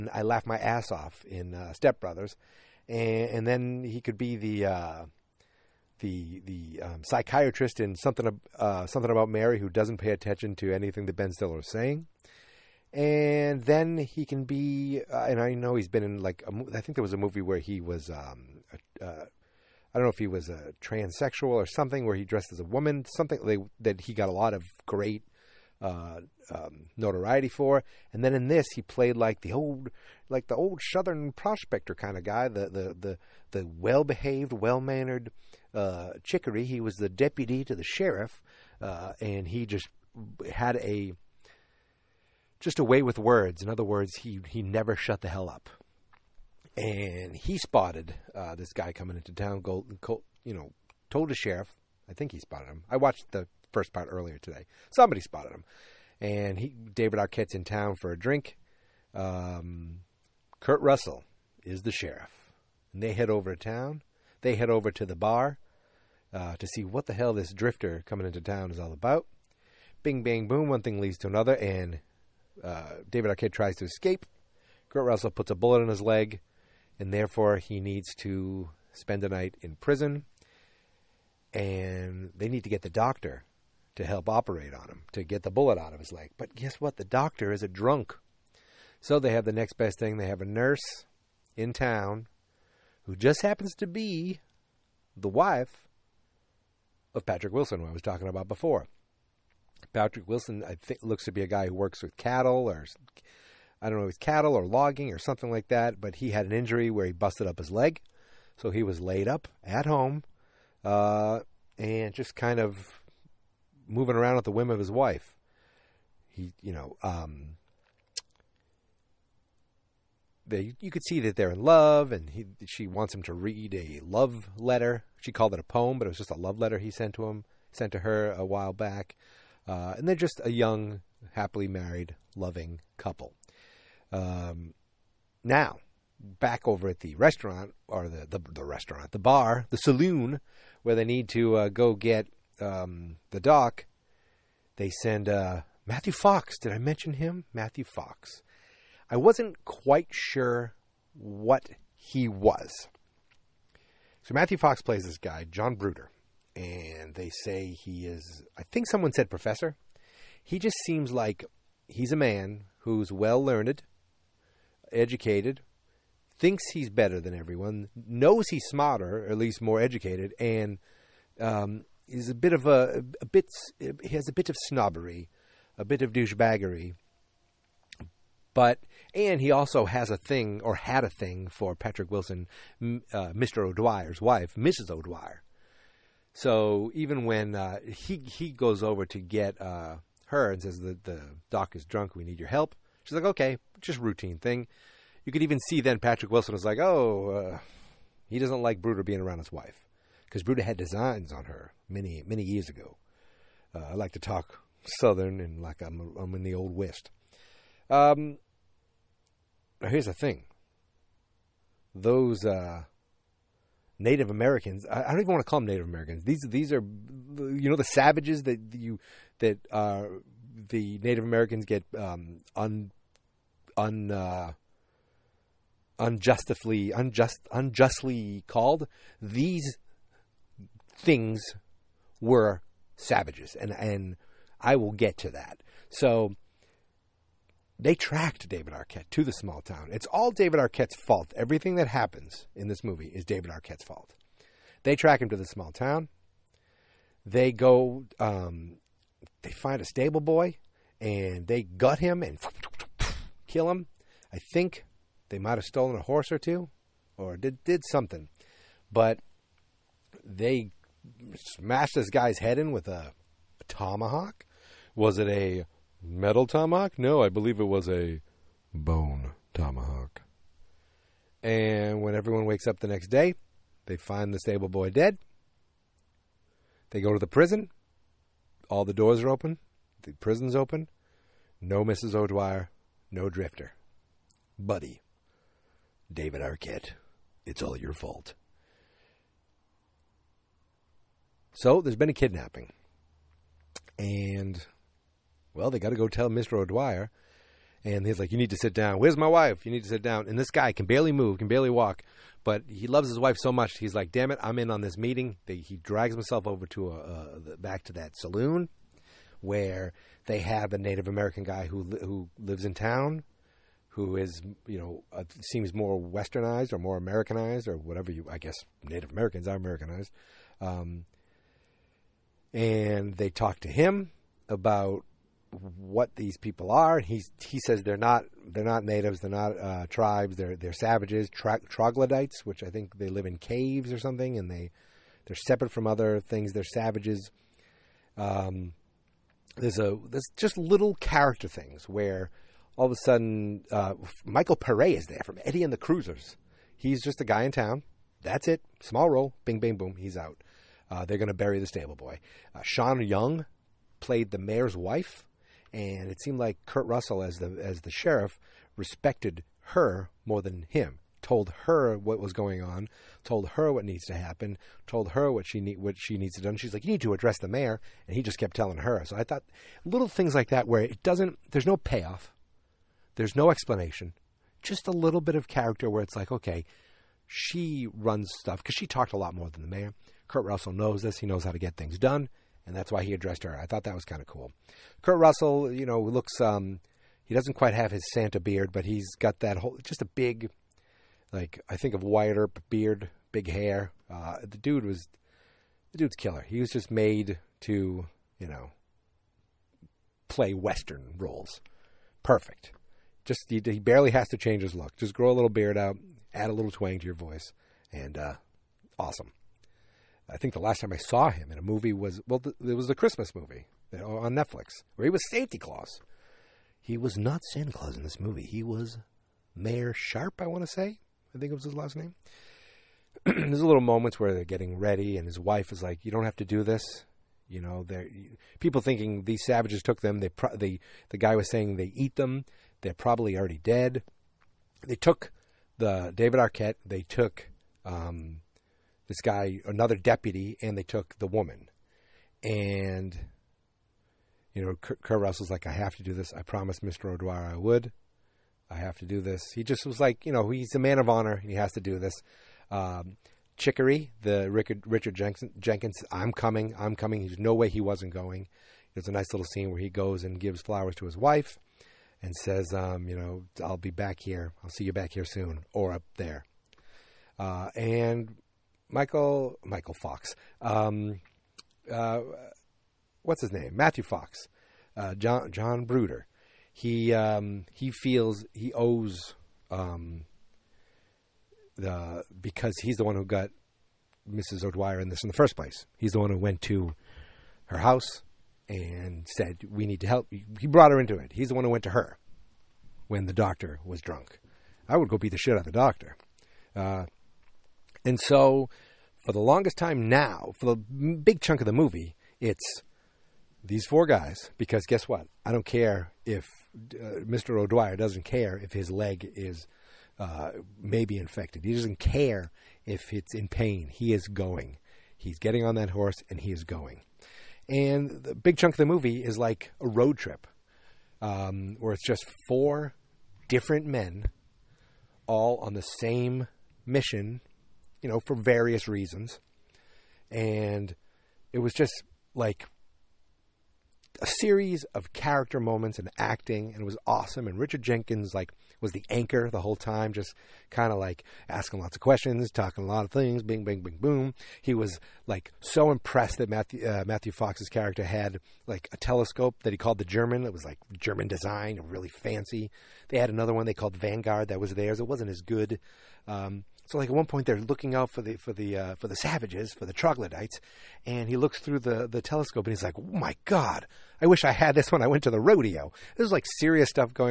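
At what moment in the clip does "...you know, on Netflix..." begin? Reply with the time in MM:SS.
06:53.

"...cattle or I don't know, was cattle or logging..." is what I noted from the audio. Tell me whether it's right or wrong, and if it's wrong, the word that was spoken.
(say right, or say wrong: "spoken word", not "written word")
right.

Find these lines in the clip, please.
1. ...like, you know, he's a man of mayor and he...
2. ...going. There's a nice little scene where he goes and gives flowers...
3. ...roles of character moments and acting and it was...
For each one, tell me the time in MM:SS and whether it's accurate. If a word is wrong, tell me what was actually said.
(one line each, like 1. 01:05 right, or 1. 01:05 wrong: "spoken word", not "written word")
1. 07:29 wrong: "honor", not "mayor"
2. 07:38 right
3. 08:54 wrong: "series", not "roles".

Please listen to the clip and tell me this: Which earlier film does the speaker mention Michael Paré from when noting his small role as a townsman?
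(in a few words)
Eddie and the Cruisers.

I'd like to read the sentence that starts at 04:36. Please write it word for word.
They go to the prison all the doors are open, the prison's open.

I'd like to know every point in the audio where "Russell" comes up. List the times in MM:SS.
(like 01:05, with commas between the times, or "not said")
01:00, 01:15, 05:56, 06:20, 06:25, 07:25.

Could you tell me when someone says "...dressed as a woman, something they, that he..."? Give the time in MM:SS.
00:22.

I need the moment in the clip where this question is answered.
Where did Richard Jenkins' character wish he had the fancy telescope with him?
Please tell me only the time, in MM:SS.
09:25.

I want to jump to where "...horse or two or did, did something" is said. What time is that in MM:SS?
04:16.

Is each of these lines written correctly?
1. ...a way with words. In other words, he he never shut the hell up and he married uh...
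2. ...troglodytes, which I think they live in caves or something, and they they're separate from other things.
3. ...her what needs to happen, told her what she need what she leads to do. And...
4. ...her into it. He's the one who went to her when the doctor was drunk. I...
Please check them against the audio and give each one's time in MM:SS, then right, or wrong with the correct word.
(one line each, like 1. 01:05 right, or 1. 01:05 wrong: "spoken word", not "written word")
1. 00:42 wrong: "spotted", not "married"
2. 05:31 right
3. 06:03 wrong: "needs", not "leads"
4. 08:10 right.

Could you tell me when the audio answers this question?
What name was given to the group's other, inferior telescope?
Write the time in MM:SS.
09:13.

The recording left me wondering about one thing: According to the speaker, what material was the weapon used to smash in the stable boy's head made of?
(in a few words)
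bone.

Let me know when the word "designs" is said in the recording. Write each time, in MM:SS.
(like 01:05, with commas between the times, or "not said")
03:20, 09:11.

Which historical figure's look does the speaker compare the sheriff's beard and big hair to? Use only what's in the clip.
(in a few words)
Wyatt Earp.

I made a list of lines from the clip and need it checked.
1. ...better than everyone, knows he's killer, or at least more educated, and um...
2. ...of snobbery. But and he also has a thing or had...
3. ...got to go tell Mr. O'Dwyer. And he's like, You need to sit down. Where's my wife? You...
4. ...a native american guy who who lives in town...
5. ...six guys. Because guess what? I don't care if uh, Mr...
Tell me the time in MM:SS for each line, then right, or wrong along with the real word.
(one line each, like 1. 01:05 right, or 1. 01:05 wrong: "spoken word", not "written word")
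1. 02:46 wrong: "smarter", not "killer"
2. 02:56 wrong: "douchebaggery", not "snobbery"
3. 04:55 right
4. 05:10 right
5. 08:23 wrong: "four", not "six".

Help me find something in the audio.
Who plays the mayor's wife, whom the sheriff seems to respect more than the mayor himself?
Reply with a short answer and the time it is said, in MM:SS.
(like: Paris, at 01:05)
Sean Young, at 05:52.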